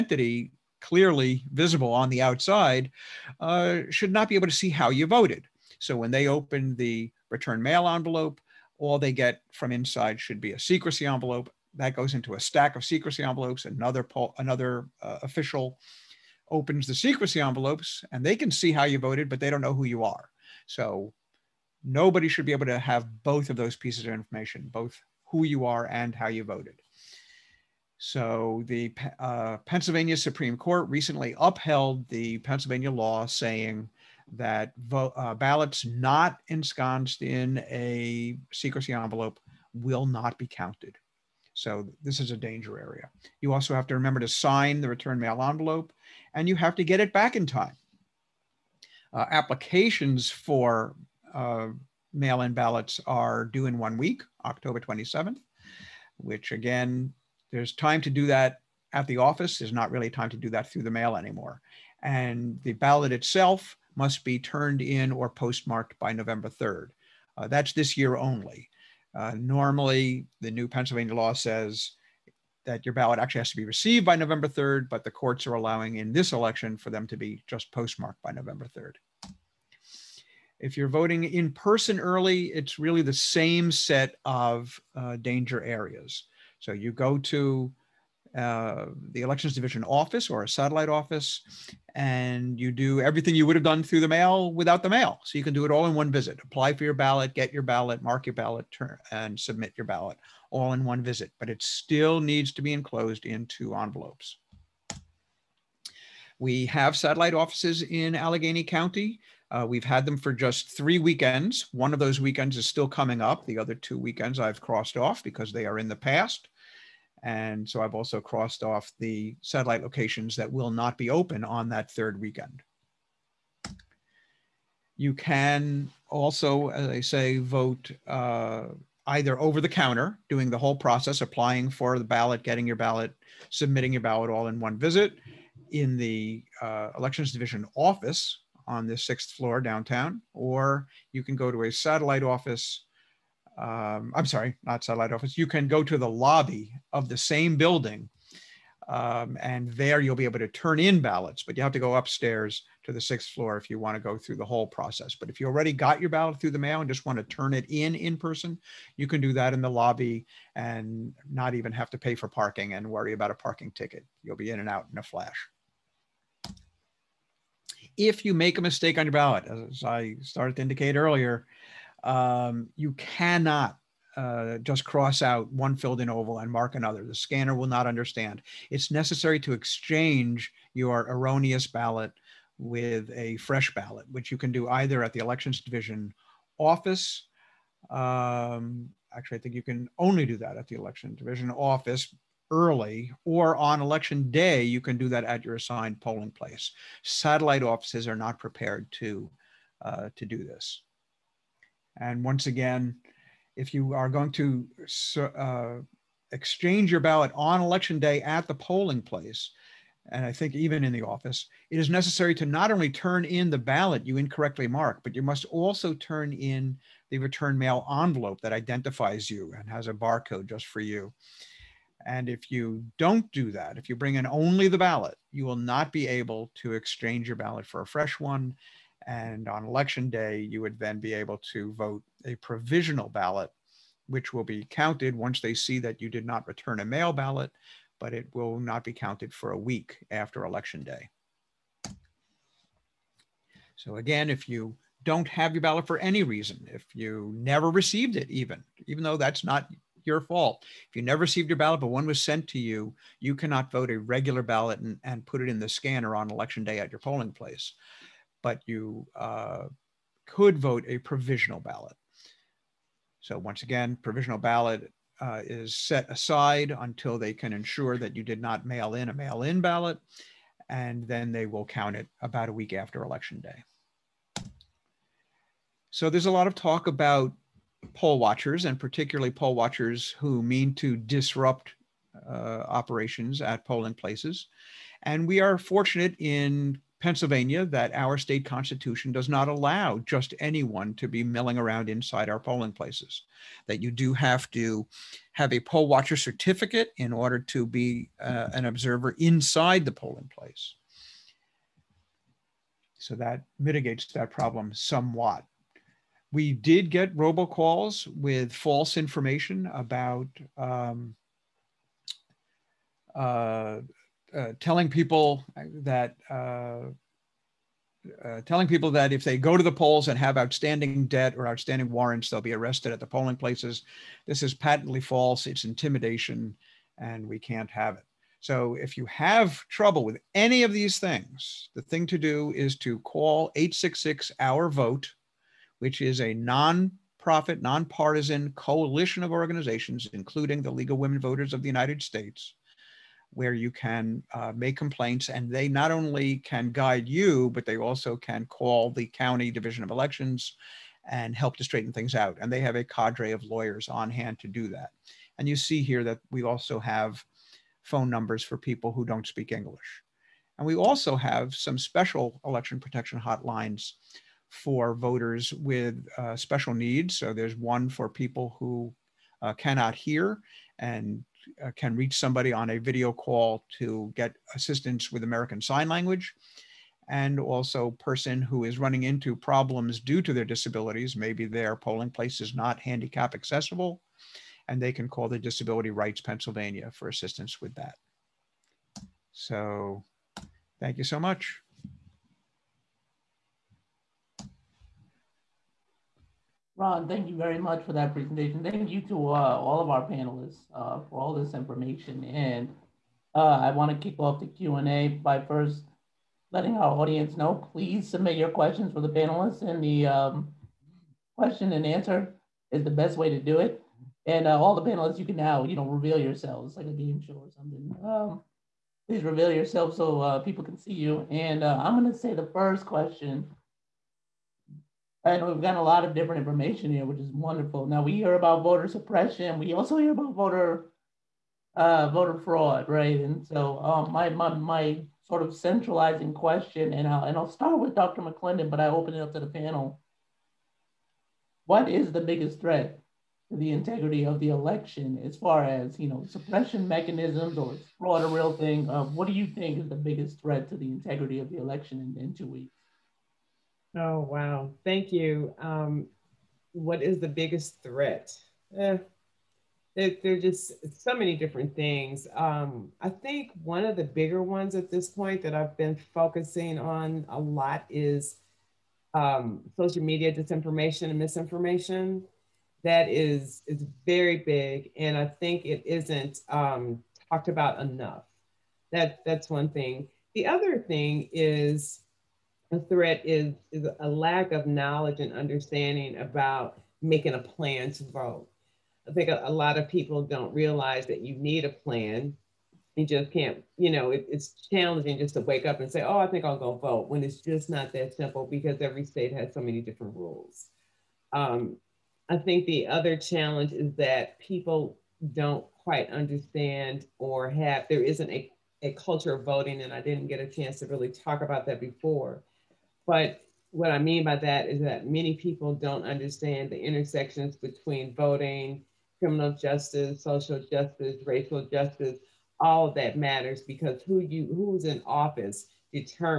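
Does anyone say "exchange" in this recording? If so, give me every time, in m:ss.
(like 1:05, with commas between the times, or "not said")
2:59, 3:26, 3:46.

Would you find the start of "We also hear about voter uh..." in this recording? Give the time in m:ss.
7:09.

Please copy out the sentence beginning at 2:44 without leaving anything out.
You'll be in and out in a flash.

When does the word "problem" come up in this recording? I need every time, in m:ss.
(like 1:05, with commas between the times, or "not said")
5:04, 6:19.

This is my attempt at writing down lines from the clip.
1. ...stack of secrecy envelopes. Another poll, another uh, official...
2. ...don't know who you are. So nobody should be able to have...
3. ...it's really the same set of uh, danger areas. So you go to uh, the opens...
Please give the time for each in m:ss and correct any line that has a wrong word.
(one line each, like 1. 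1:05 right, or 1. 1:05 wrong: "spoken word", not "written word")
1. 0:12 right
2. 0:19 right
3. 1:22 wrong: "elections", not "opens".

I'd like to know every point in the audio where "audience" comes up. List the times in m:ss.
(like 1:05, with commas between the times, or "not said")
6:46.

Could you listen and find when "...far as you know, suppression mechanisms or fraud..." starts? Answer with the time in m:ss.
7:25.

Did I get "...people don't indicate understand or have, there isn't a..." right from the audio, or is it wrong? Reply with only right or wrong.
wrong.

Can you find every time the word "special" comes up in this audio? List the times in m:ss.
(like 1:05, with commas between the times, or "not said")
6:01, 6:06.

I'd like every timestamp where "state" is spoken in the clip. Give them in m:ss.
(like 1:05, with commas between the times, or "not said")
4:48, 5:42, 8:19.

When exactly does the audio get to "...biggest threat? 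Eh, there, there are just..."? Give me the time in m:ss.
7:37.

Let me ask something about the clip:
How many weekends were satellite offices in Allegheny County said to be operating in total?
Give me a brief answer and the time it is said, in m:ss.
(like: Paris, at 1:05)
3, at 1:50.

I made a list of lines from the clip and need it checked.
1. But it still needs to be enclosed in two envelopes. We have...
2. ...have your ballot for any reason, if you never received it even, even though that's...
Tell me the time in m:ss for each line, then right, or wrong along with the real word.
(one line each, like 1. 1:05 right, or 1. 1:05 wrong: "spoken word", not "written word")
1. 1:41 right
2. 4:05 right.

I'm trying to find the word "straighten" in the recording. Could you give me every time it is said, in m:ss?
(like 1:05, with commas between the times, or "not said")
5:51.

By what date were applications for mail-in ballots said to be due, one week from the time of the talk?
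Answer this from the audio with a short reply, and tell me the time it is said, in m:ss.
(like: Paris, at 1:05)
October 27th, at 0:54.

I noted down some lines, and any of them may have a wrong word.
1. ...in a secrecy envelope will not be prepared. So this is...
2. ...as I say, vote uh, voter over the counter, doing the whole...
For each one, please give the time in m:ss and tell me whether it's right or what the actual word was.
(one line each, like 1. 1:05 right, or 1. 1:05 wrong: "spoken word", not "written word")
1. 0:37 wrong: "counted", not "prepared"
2. 2:06 wrong: "either", not "voter".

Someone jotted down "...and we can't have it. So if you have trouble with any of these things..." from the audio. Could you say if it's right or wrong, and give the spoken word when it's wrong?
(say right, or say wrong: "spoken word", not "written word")
right.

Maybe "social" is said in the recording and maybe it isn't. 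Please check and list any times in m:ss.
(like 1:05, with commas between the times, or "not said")
7:49, 8:40.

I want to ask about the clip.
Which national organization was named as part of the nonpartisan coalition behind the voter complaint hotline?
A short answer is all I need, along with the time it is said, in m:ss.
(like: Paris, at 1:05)
League of Women Voters, at 5:40.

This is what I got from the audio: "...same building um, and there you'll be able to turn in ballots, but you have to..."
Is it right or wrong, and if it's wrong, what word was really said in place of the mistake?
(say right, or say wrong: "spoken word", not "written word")
right.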